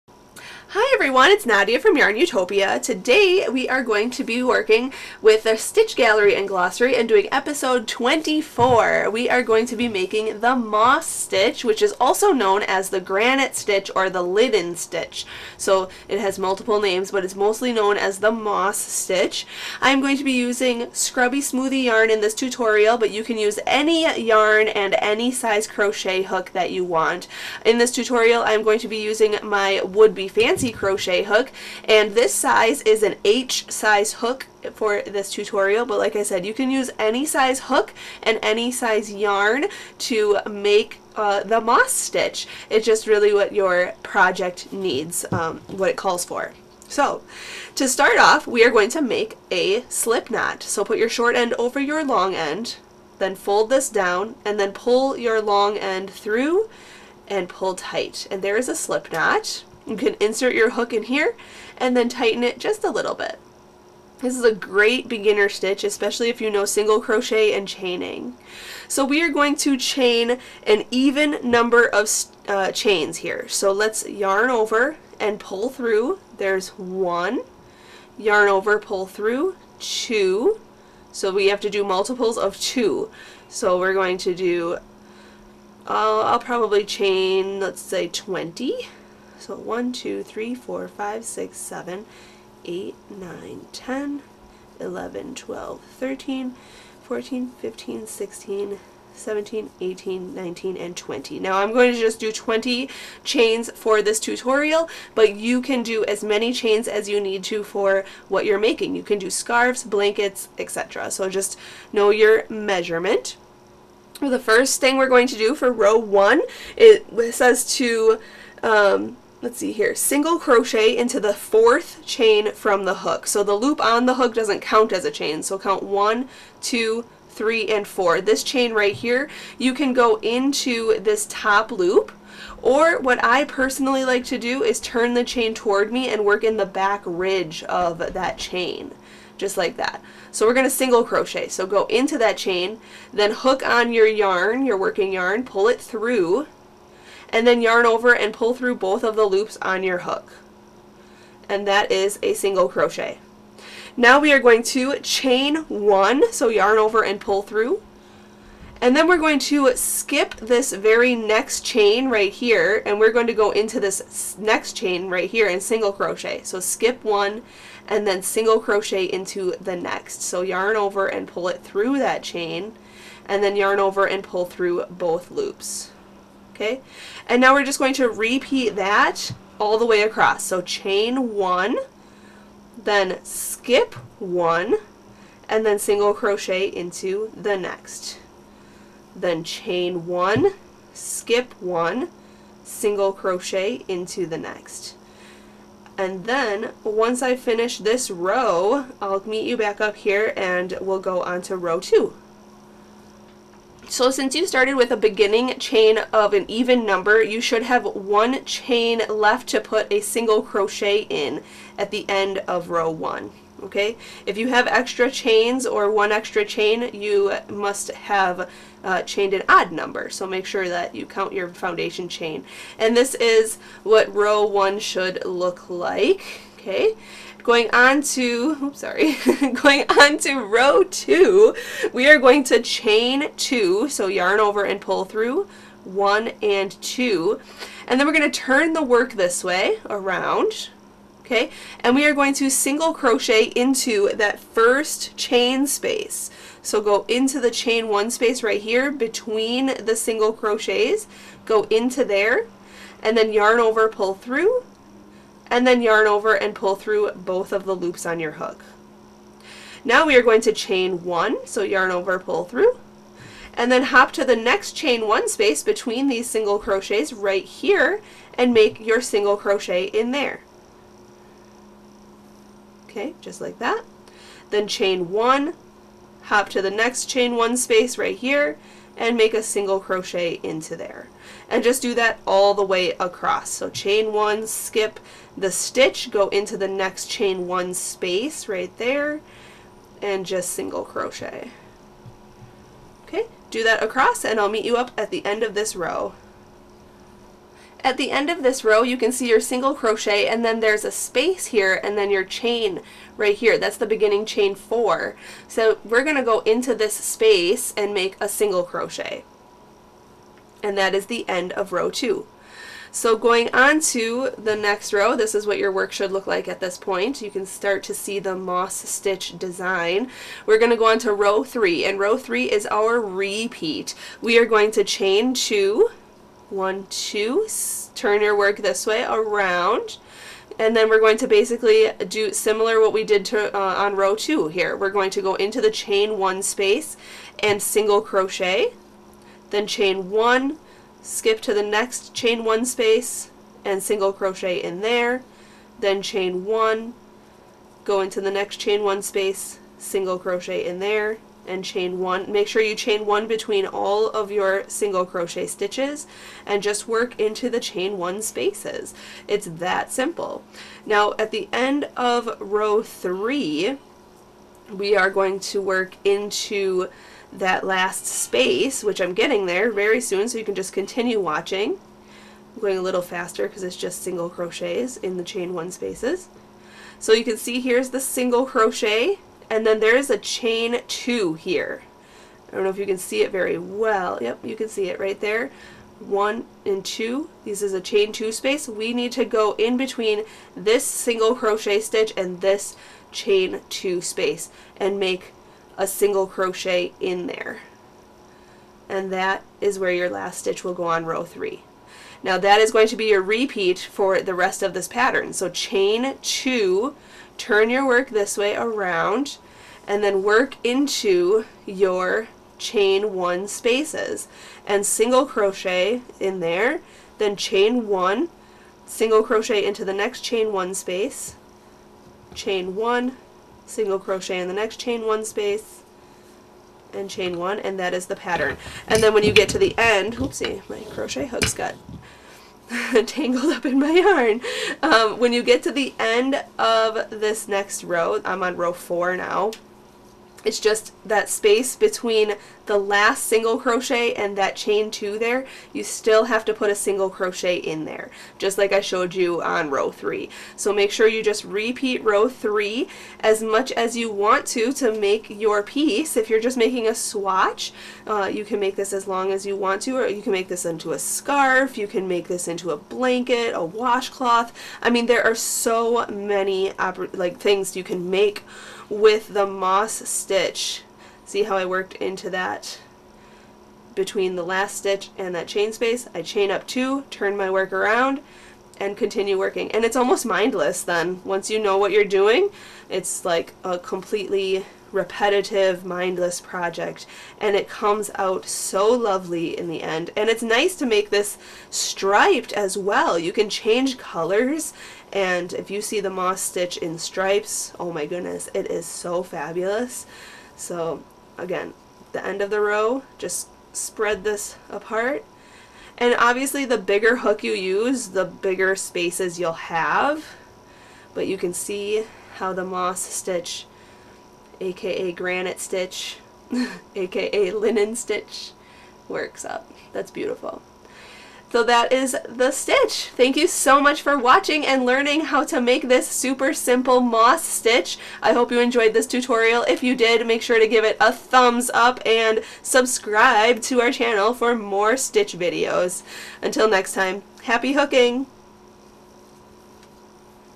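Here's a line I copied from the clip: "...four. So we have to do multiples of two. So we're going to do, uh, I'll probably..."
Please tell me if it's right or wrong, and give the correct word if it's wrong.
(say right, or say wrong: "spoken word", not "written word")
wrong: "two", not "four".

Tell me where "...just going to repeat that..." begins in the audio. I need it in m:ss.
2:57.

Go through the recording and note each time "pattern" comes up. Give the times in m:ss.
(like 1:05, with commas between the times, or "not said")
6:44, 7:08.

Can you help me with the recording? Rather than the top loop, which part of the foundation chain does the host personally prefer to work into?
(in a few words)
back ridge.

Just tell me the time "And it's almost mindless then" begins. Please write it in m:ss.
7:59.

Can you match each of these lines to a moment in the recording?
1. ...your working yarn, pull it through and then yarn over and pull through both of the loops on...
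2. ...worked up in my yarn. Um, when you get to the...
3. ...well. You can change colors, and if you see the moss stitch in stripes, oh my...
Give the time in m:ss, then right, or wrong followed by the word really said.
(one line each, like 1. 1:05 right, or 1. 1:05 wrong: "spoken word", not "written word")
1. 2:24 right
2. 7:13 wrong: "tangled", not "worked"
3. 8:12 right.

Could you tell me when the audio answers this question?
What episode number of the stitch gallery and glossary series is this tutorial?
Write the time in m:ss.
0:07.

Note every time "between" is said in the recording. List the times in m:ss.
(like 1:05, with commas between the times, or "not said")
4:08, 4:25, 5:53, 6:29, 7:21, 7:53.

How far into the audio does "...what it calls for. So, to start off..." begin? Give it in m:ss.
0:45.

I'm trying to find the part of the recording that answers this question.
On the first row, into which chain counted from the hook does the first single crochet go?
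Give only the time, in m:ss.
2:01.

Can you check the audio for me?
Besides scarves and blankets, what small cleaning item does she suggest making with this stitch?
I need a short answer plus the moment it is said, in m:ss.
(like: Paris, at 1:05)
washcloth, at 7:43.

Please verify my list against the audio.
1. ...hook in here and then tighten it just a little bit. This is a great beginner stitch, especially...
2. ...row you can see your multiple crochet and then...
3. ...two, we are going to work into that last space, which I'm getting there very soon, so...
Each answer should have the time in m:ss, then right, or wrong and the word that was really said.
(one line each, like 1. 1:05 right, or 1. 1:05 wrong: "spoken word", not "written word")
1. 1:00 right
2. 4:58 wrong: "single", not "multiple"
3. 6:02 wrong: "three", not "two".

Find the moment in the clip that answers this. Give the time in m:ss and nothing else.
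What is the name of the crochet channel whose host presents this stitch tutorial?
0:01.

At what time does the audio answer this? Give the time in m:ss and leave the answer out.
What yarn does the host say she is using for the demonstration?
0:20.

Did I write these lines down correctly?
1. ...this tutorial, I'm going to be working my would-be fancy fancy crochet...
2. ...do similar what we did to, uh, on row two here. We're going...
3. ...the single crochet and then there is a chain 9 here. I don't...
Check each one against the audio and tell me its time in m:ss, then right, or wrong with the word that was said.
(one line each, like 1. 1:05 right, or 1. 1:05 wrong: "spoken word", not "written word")
1. 0:27 wrong: "using", not "working"
2. 5:32 right
3. 6:17 wrong: "2", not "9".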